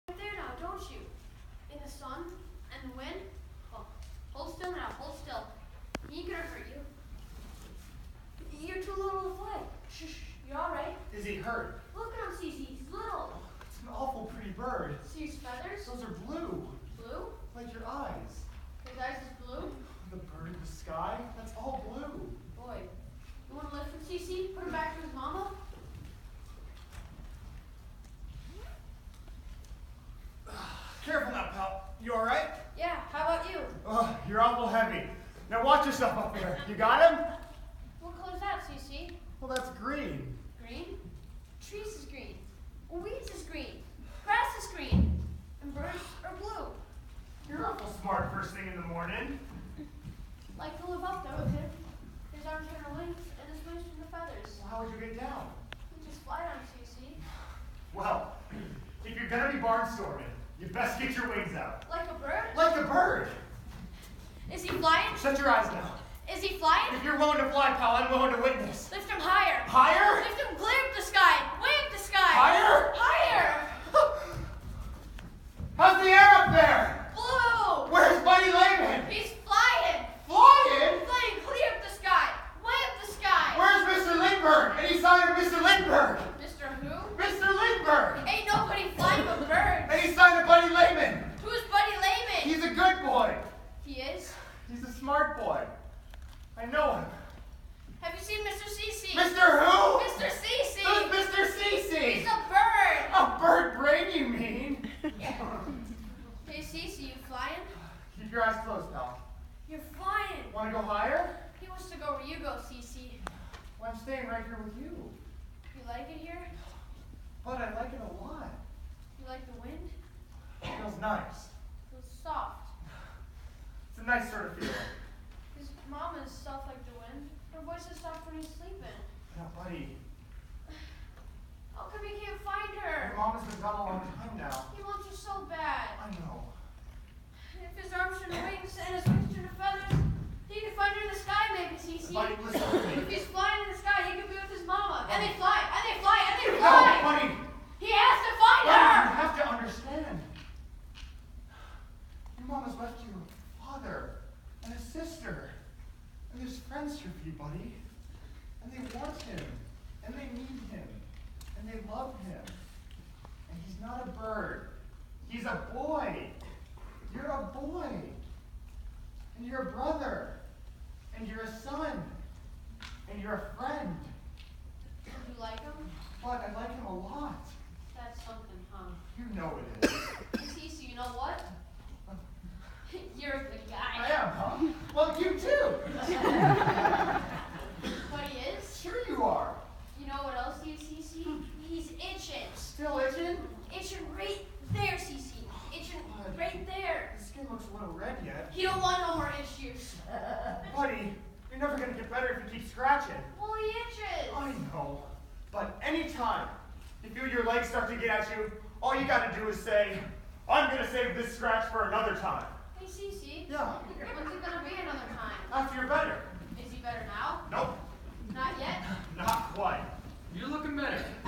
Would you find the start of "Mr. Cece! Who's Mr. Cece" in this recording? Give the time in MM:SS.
01:40.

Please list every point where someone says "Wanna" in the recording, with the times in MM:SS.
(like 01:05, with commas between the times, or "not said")
01:50.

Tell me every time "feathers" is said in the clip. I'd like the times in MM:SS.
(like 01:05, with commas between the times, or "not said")
00:15, 00:54.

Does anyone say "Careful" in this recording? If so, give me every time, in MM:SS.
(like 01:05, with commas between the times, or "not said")
00:31.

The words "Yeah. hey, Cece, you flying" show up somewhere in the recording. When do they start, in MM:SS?
01:45.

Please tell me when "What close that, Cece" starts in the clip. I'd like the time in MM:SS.
00:38.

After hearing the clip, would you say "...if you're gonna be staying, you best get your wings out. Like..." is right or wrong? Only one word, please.
wrong.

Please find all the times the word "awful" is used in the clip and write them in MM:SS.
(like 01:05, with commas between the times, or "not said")
00:13, 00:34.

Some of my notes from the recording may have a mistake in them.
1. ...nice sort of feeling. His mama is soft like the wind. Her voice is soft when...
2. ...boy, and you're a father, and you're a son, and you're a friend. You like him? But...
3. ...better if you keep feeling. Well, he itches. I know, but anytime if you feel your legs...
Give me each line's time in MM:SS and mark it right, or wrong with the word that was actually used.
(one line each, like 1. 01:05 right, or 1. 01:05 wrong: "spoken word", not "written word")
1. 02:04 right
2. 02:47 wrong: "brother", not "father"
3. 03:22 wrong: "scratching", not "feeling".